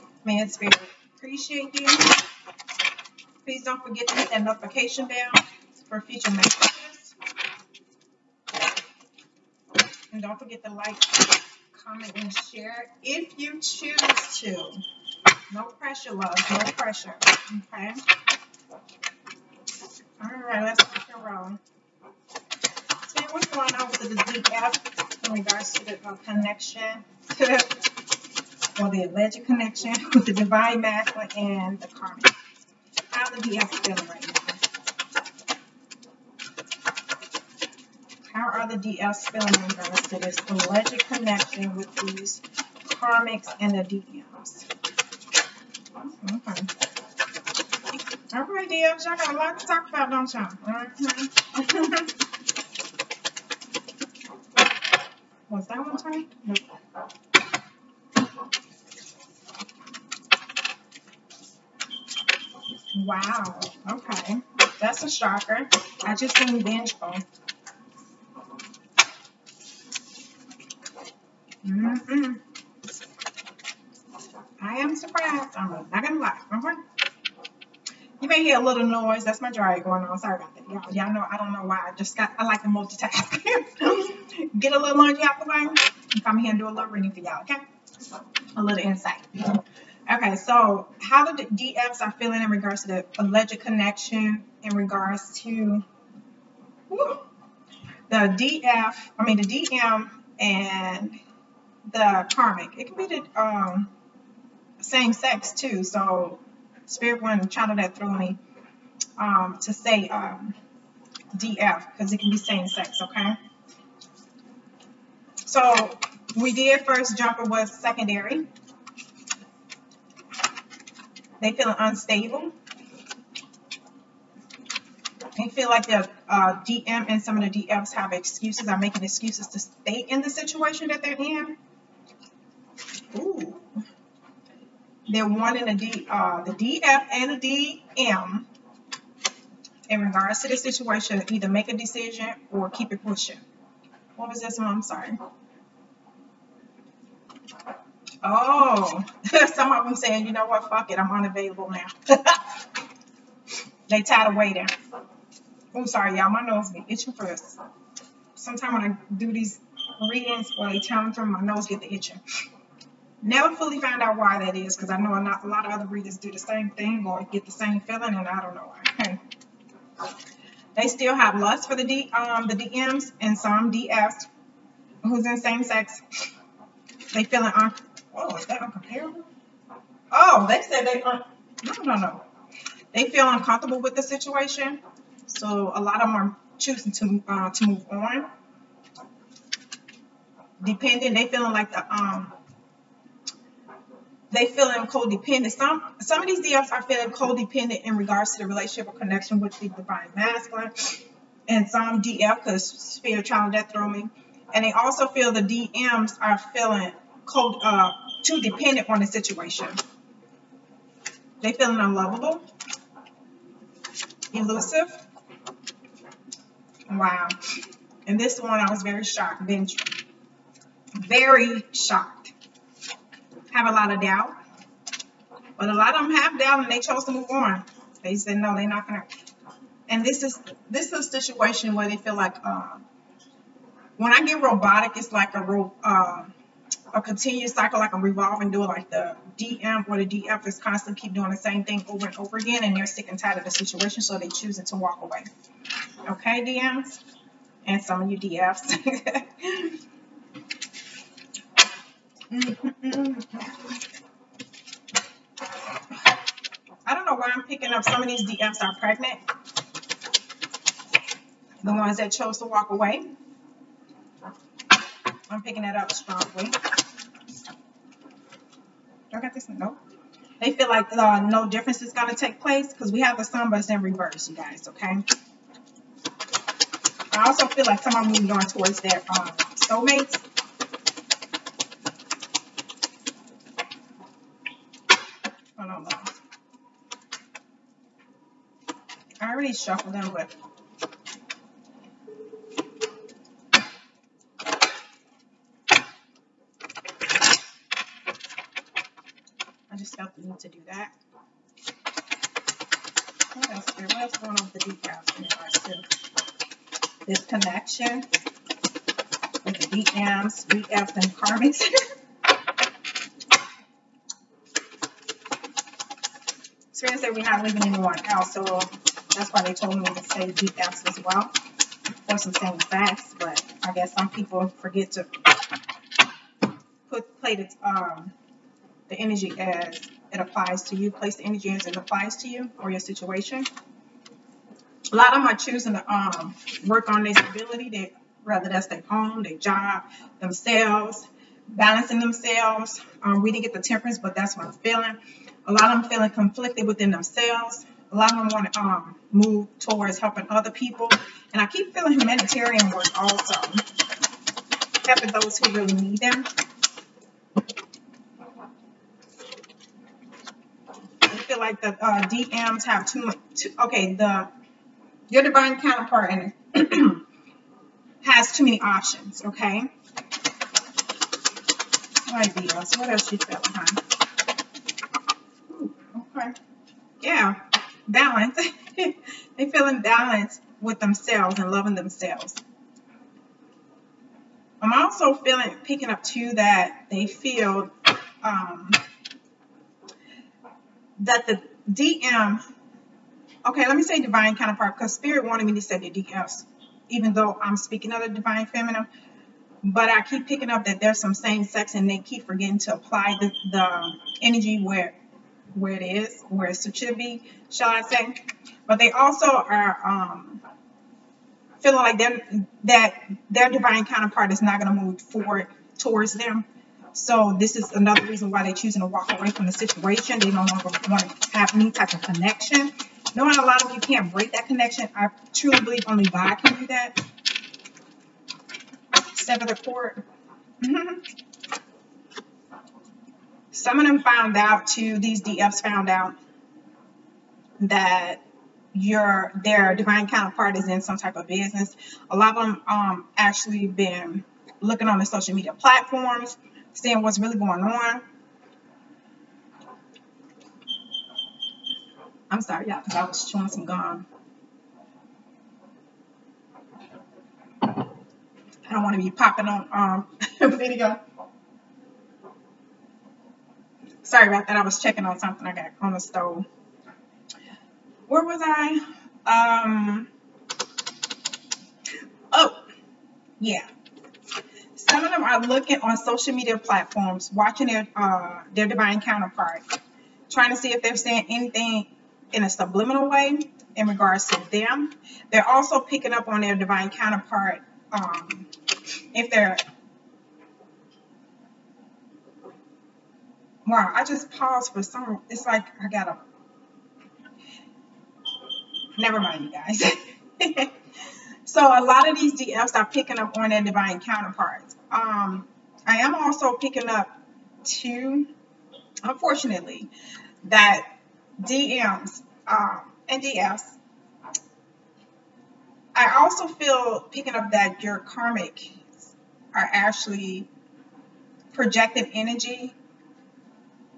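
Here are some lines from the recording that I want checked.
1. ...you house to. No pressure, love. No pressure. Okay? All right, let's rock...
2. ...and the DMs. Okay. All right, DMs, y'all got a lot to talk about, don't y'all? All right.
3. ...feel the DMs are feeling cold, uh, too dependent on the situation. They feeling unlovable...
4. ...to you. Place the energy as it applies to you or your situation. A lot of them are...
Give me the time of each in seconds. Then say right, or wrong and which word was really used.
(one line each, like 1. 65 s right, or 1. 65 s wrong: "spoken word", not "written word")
1. 13 s wrong: "choose", not "house"
2. 43 s right
3. 205 s right
4. 330 s right.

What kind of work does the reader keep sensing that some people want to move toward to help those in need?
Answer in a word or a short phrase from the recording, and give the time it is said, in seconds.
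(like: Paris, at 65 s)
humanitarian work, at 351 s.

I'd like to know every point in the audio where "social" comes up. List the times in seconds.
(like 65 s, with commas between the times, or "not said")
445 s, 475 s.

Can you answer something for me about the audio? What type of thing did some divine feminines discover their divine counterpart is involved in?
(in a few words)
business.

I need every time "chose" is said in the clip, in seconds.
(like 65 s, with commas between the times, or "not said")
226 s, 262 s.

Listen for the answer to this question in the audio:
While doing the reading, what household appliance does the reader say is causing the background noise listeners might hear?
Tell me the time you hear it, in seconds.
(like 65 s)
79 s.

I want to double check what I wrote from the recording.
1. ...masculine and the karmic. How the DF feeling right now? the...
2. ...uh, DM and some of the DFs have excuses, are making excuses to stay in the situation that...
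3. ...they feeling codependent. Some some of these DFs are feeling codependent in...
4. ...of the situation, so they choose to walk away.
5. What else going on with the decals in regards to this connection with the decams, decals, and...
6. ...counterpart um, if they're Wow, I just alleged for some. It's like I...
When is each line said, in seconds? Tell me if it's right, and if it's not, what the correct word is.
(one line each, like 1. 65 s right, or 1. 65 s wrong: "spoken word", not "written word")
1. 30 s right
2. 126 s right
3. 194 s right
4. 243 s right
5. 303 s right
6. 486 s wrong: "paused", not "alleged".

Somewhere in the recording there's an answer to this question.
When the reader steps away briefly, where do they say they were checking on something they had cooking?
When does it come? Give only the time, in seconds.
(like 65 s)
465 s.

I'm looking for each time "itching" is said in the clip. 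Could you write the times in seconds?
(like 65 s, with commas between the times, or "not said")
156 s, 161 s.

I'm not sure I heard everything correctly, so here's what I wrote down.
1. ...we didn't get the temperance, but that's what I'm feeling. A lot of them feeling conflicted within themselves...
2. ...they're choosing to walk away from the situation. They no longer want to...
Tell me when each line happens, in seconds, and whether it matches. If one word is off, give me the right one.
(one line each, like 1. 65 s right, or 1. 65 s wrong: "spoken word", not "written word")
1. 343 s right
2. 418 s right.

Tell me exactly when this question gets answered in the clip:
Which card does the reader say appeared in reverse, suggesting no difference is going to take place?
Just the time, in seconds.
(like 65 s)
273 s.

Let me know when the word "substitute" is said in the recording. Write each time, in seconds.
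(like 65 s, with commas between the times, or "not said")
not said.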